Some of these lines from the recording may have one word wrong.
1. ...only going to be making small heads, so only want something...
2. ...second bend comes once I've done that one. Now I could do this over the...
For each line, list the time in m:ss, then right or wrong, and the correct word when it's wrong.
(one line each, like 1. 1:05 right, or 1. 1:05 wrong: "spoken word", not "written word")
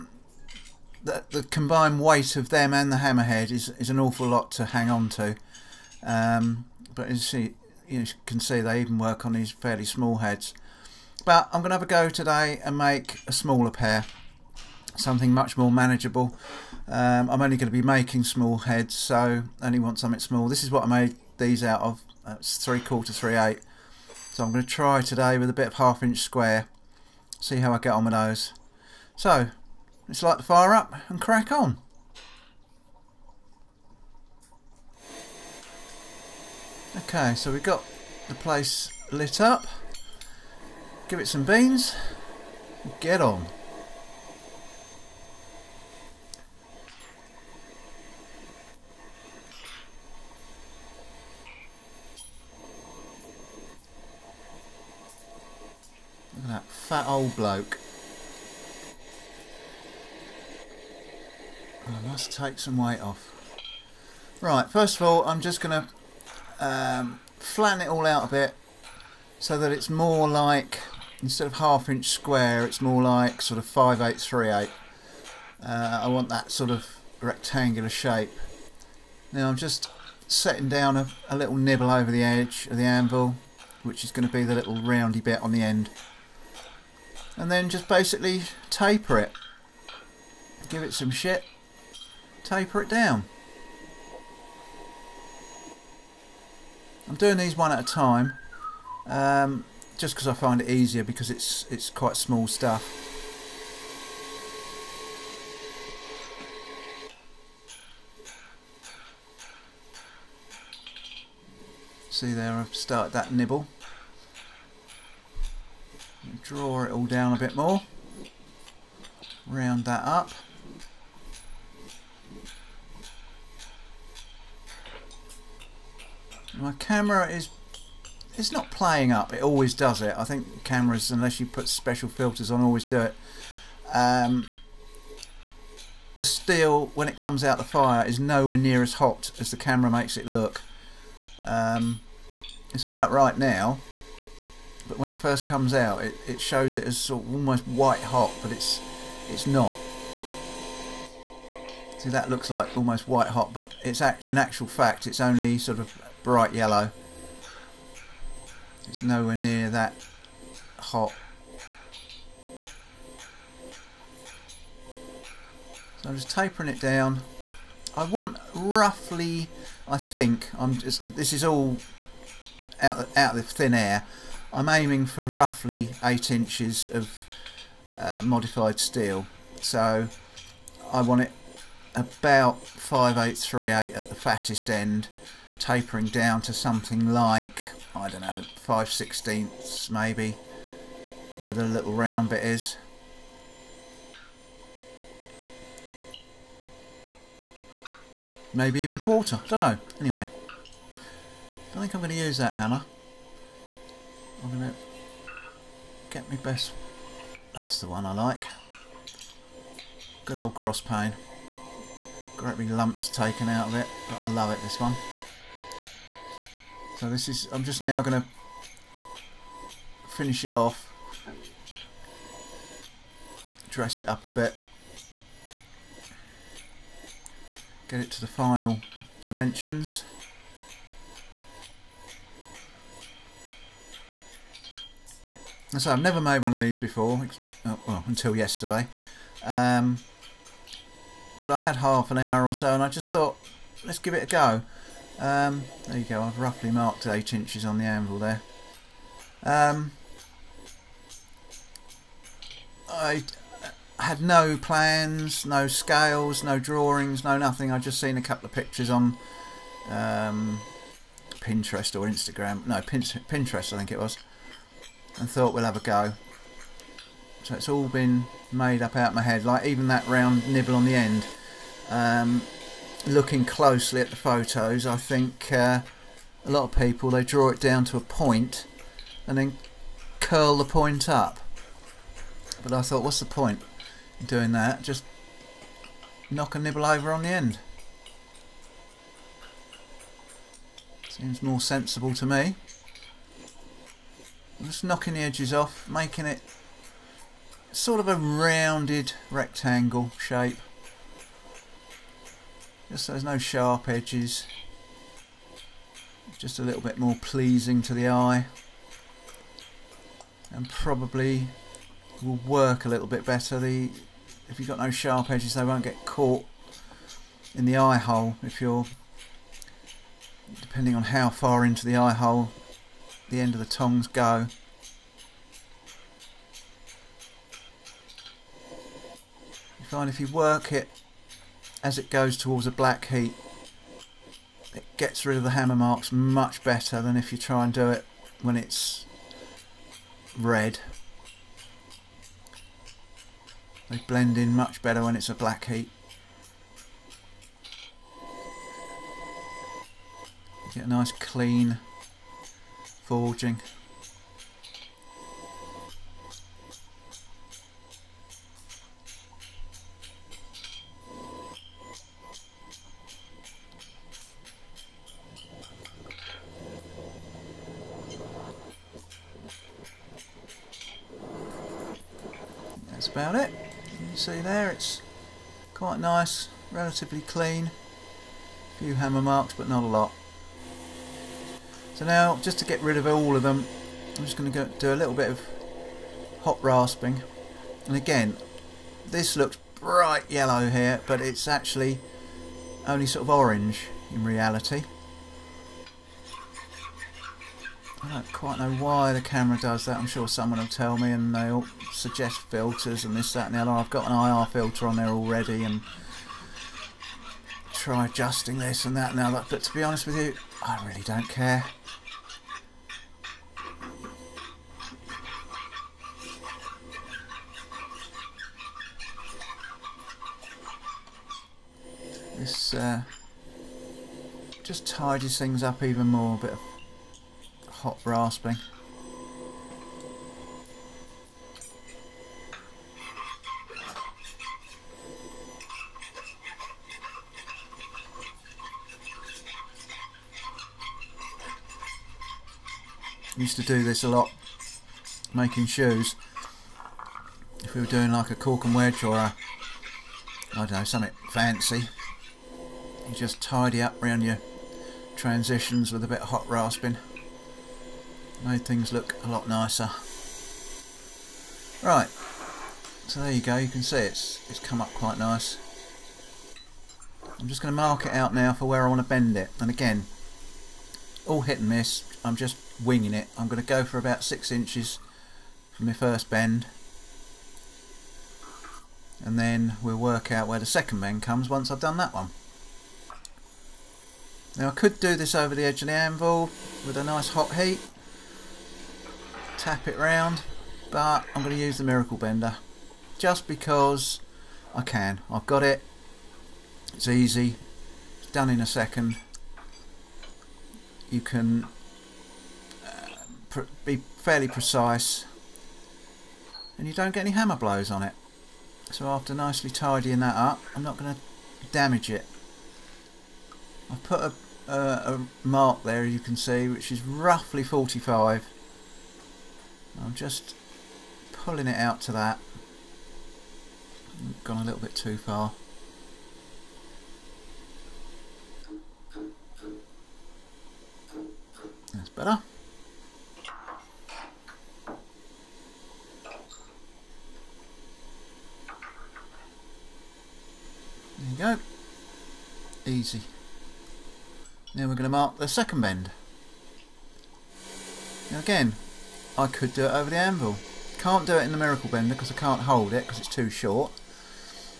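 1. 0:17 right
2. 8:00 right.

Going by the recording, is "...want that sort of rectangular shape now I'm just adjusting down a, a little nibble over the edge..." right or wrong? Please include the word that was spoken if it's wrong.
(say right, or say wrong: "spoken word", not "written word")
wrong: "setting", not "adjusting".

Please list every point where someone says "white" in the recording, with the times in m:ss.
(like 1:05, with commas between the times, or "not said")
2:27, 2:33.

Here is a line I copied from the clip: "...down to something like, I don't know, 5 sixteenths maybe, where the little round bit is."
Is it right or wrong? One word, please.
right.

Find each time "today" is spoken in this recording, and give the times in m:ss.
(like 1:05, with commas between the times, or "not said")
0:12, 0:25.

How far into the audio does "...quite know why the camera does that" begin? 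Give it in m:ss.
6:38.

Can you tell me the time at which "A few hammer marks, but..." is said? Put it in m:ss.
6:18.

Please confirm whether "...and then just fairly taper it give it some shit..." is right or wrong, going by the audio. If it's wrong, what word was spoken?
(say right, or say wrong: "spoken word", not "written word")
wrong: "basically", not "fairly".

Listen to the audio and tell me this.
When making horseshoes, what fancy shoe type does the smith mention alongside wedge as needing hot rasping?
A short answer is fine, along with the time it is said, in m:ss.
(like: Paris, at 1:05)
cork, at 7:28.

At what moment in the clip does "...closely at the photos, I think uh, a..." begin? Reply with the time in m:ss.
4:33.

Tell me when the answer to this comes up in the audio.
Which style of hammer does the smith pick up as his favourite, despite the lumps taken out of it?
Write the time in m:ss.
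3:30.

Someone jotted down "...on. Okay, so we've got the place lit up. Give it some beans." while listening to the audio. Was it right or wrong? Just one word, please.
right.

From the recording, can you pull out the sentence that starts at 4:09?
Um, I had no plans, no scales, no drawings, no nothing.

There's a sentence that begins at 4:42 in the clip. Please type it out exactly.
But I thought, what's the point in doing that?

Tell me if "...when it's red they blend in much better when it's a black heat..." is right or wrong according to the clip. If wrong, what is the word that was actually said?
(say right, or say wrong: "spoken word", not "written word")
right.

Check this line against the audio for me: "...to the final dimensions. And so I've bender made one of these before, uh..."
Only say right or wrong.
wrong.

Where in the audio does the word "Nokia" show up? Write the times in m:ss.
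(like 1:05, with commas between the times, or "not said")
not said.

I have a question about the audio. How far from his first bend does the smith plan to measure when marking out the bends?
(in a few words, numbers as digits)
6 inches.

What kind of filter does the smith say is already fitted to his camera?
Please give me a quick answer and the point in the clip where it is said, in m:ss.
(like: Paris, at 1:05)
IR filter, at 6:44.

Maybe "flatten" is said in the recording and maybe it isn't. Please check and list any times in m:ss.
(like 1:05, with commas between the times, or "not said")
1:07.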